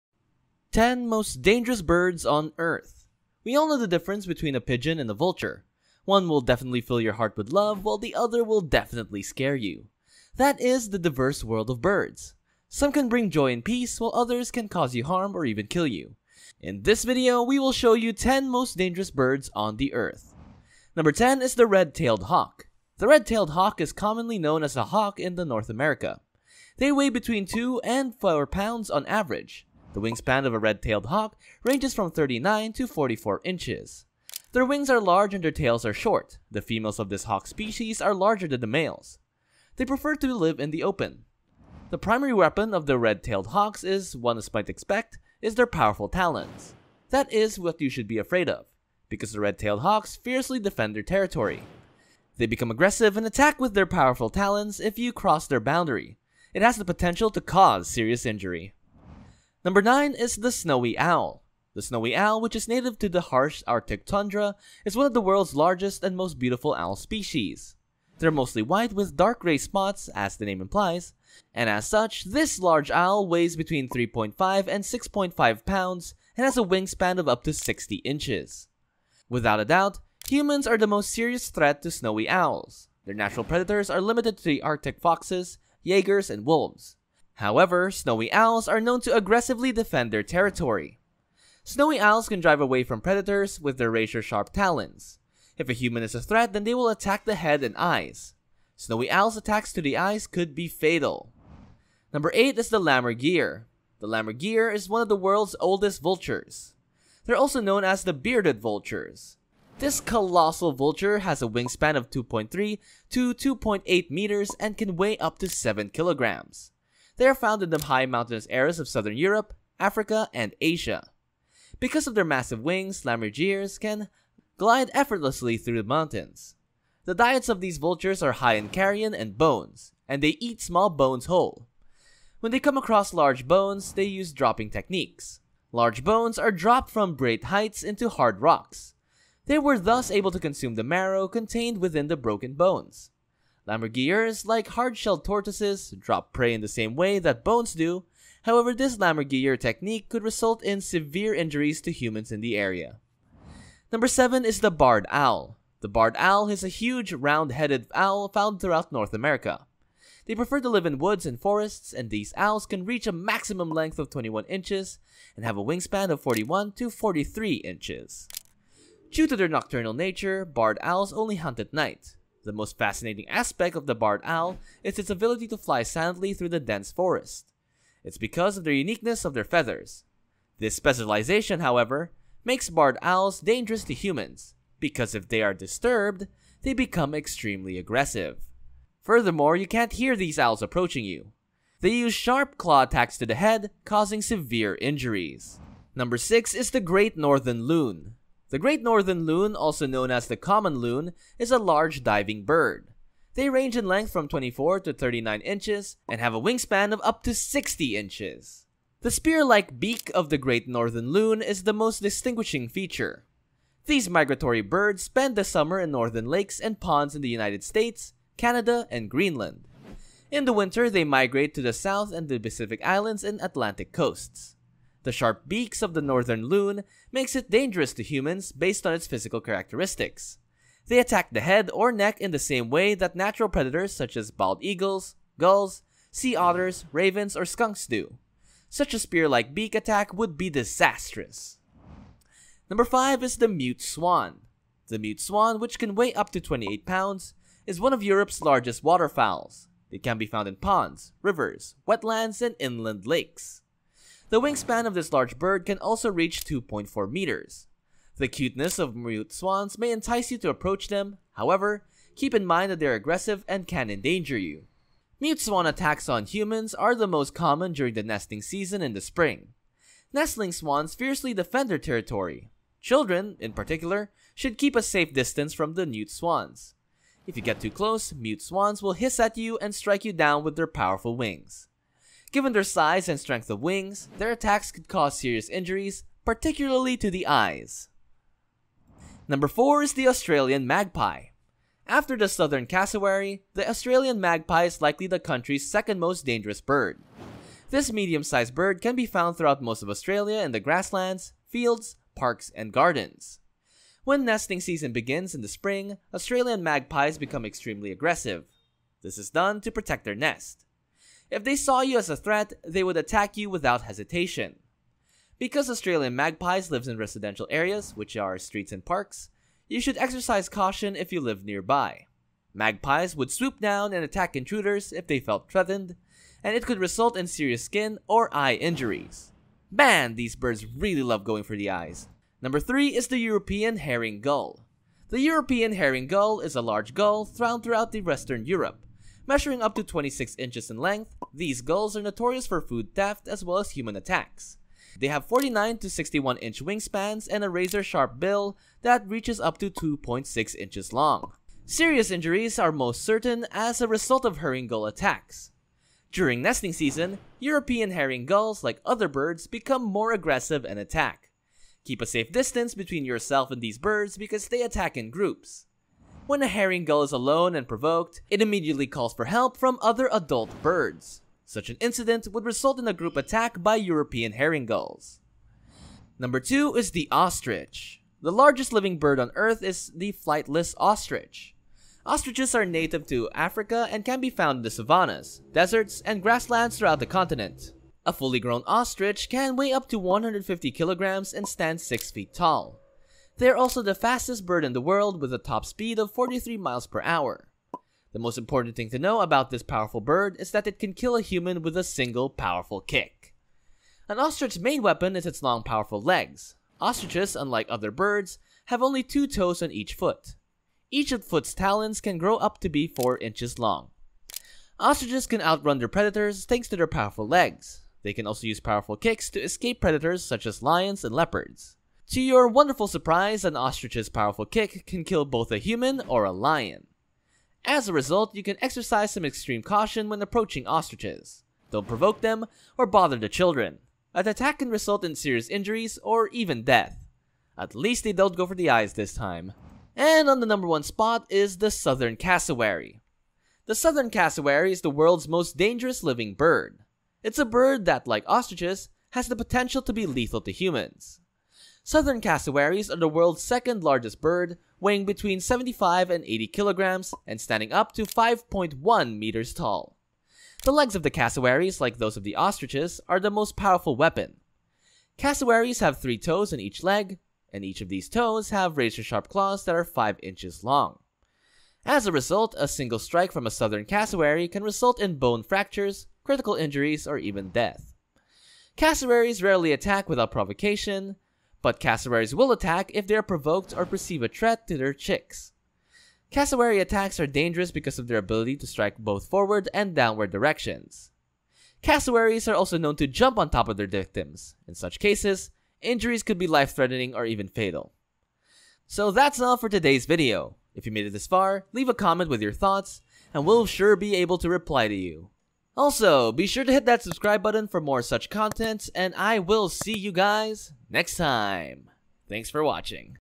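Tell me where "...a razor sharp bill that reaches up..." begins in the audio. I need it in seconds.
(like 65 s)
347 s.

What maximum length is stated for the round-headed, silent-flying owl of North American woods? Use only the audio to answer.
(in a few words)
21 inches.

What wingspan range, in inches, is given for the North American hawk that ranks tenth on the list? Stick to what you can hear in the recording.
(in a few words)
39 to 44 inches.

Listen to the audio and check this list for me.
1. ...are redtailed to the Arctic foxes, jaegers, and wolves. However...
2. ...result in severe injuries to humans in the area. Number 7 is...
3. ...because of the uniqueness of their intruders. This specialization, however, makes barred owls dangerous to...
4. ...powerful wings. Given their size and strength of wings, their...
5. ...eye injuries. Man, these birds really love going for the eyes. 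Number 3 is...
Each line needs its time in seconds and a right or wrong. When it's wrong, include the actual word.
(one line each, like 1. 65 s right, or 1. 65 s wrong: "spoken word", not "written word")
1. 83 s wrong: "limited", not "redtailed"
2. 150 s right
3. 178 s wrong: "feathers", not "intruders"
4. 280 s right
5. 328 s right.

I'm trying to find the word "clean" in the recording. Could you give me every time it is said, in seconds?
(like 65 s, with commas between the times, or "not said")
not said.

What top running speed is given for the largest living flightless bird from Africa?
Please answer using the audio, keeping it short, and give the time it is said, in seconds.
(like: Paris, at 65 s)
43 miles per hour, at 396 s.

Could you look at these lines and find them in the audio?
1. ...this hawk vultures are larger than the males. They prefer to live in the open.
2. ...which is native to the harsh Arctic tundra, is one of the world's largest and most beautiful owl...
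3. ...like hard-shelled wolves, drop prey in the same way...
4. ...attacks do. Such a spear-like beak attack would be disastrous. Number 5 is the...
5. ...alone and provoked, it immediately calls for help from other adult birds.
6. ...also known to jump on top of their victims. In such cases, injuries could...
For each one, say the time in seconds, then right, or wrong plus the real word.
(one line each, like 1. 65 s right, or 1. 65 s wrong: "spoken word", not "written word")
1. 37 s wrong: "species", not "vultures"
2. 62 s right
3. 144 s wrong: "tortoises", not "wolves"
4. 237 s wrong: "skunks", not "attacks"
5. 367 s right
6. 492 s right.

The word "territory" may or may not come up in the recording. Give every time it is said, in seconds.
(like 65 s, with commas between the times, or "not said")
51 s, 90 s, 271 s.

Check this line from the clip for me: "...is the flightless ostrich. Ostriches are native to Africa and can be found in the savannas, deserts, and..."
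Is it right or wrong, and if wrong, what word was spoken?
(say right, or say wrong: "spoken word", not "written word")
right.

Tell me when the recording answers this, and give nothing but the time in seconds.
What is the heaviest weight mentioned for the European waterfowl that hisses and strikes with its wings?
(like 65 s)
246 s.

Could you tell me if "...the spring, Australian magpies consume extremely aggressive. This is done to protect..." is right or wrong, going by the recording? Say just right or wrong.
wrong.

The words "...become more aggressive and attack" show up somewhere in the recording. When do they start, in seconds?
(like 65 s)
359 s.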